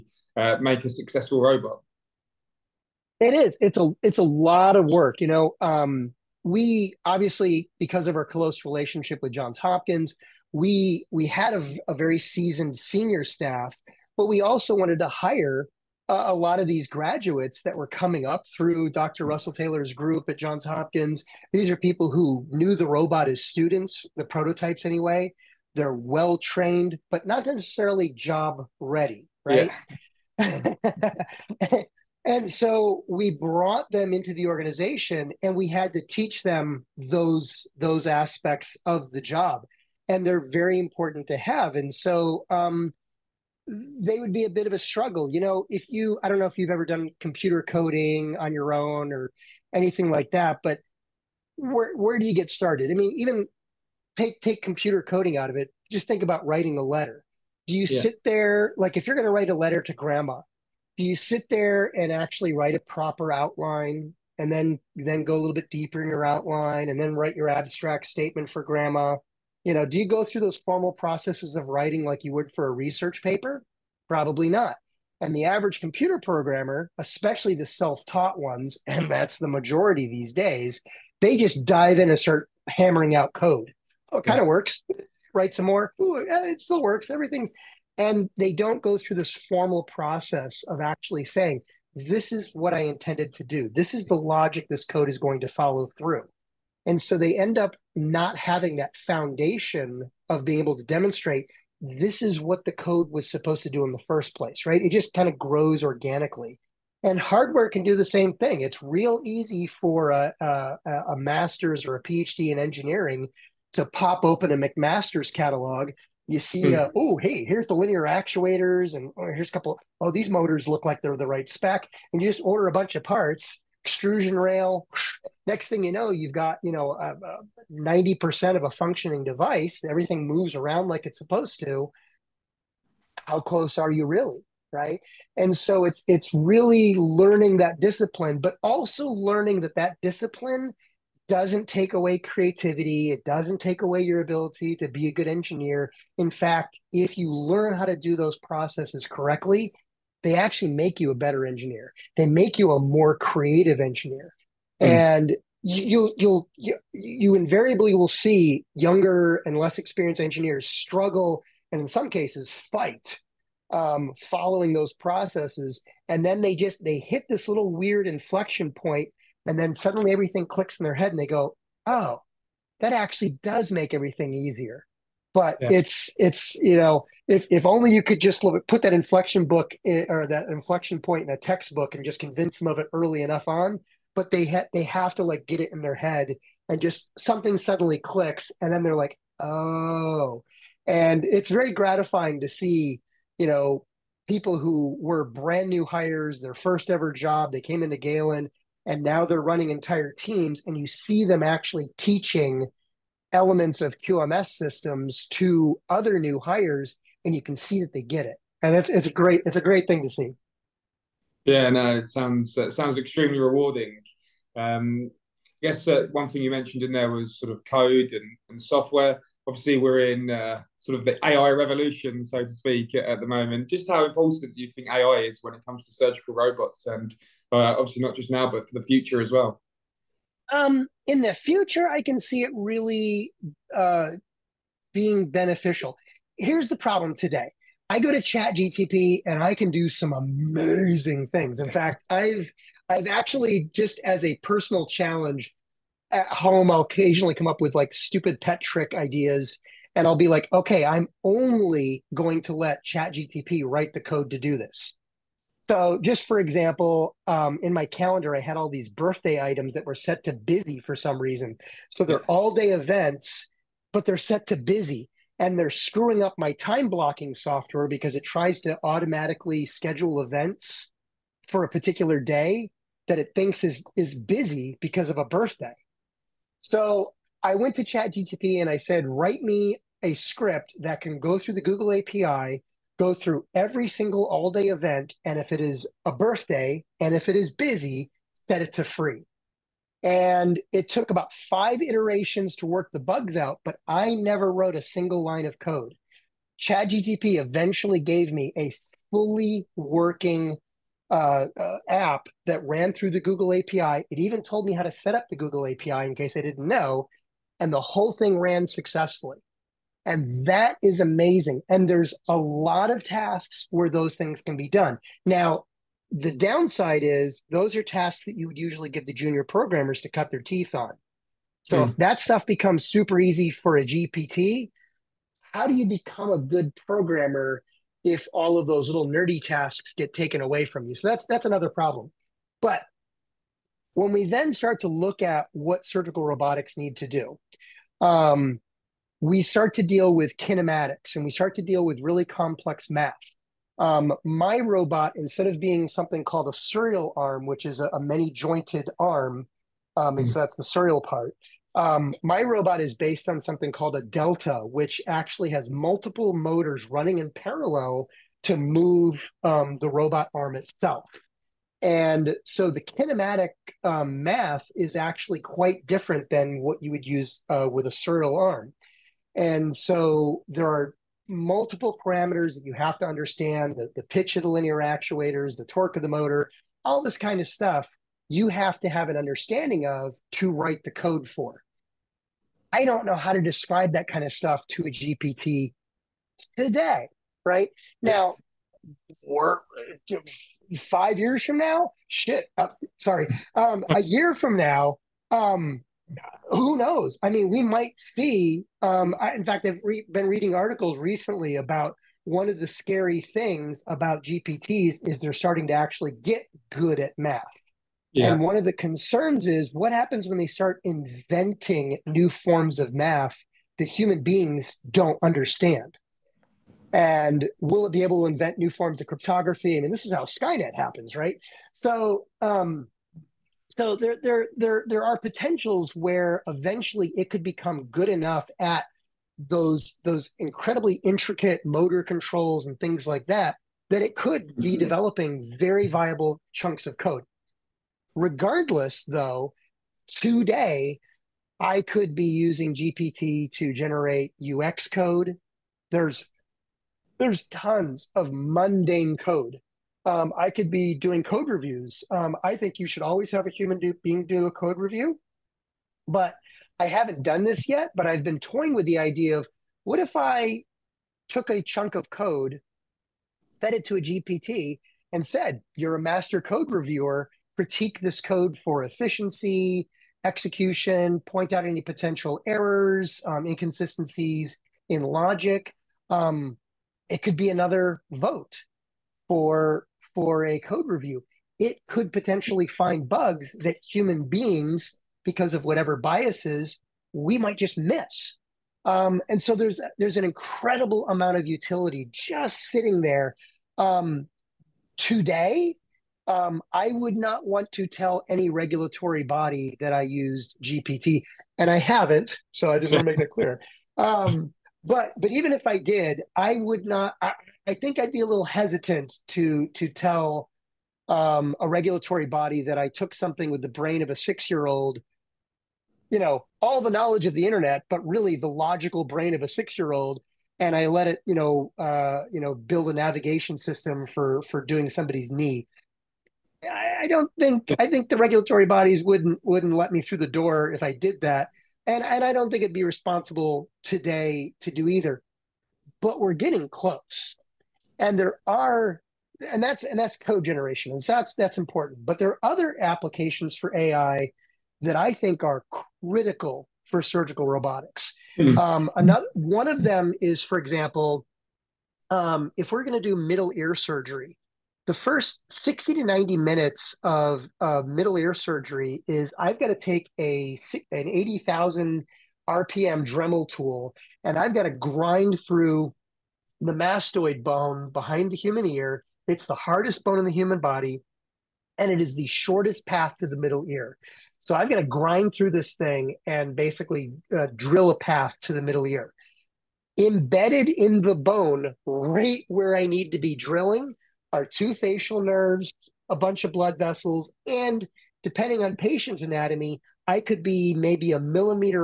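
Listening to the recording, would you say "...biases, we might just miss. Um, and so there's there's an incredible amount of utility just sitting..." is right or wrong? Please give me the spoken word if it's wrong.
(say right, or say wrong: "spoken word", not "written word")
right.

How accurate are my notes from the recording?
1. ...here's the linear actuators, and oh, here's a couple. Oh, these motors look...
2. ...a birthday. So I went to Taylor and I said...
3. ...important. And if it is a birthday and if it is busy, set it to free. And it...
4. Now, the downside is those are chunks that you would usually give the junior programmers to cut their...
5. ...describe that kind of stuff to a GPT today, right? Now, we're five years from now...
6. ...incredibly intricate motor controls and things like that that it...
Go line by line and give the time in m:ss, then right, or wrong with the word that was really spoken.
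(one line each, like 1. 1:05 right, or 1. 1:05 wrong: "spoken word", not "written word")
1. 1:57 right
2. 4:35 wrong: "ChatGTP", not "Taylor"
3. 4:44 wrong: "event", not "important"
4. 5:15 wrong: "tasks", not "chunks"
5. 6:23 right
6. 7:10 right.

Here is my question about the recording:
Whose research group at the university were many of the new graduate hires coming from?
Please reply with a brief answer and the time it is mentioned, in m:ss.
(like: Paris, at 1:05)
Dr. Russell Taylor, at 0:18.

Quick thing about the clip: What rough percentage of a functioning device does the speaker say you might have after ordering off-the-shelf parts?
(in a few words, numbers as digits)
90.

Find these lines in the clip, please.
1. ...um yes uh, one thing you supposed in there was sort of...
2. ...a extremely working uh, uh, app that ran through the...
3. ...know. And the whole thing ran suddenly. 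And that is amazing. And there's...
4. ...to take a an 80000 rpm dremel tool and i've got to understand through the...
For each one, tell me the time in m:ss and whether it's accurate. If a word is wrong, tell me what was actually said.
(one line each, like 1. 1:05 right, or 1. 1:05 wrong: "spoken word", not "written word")
1. 3:34 wrong: "mentioned", not "supposed"
2. 4:58 wrong: "fully", not "extremely"
3. 5:06 wrong: "successfully", not "suddenly"
4. 9:19 wrong: "grind", not "understand".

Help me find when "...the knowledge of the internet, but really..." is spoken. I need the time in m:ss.
8:36.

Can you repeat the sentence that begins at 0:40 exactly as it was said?
And they're very important to have.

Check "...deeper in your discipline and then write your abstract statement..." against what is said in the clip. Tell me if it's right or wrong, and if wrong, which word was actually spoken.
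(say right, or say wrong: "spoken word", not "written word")
wrong: "outline", not "discipline".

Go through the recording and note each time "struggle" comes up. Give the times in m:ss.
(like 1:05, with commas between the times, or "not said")
0:44, 2:40.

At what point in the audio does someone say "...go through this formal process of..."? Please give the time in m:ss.
1:28.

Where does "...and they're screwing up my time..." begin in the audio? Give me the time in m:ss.
4:25.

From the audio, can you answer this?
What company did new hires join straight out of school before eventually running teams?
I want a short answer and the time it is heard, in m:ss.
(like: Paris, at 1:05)
Galen, at 3:17.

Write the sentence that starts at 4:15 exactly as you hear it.
So, just for example, um, in my calendar, I had all these birthday items that were set to busy for some reason.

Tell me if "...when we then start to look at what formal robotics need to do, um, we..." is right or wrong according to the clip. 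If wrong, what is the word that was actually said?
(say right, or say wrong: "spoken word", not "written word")
wrong: "surgical", not "formal".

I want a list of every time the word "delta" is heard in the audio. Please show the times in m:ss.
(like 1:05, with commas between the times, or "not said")
5:54.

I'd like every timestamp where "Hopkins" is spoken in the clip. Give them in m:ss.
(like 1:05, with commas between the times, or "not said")
0:09, 0:20.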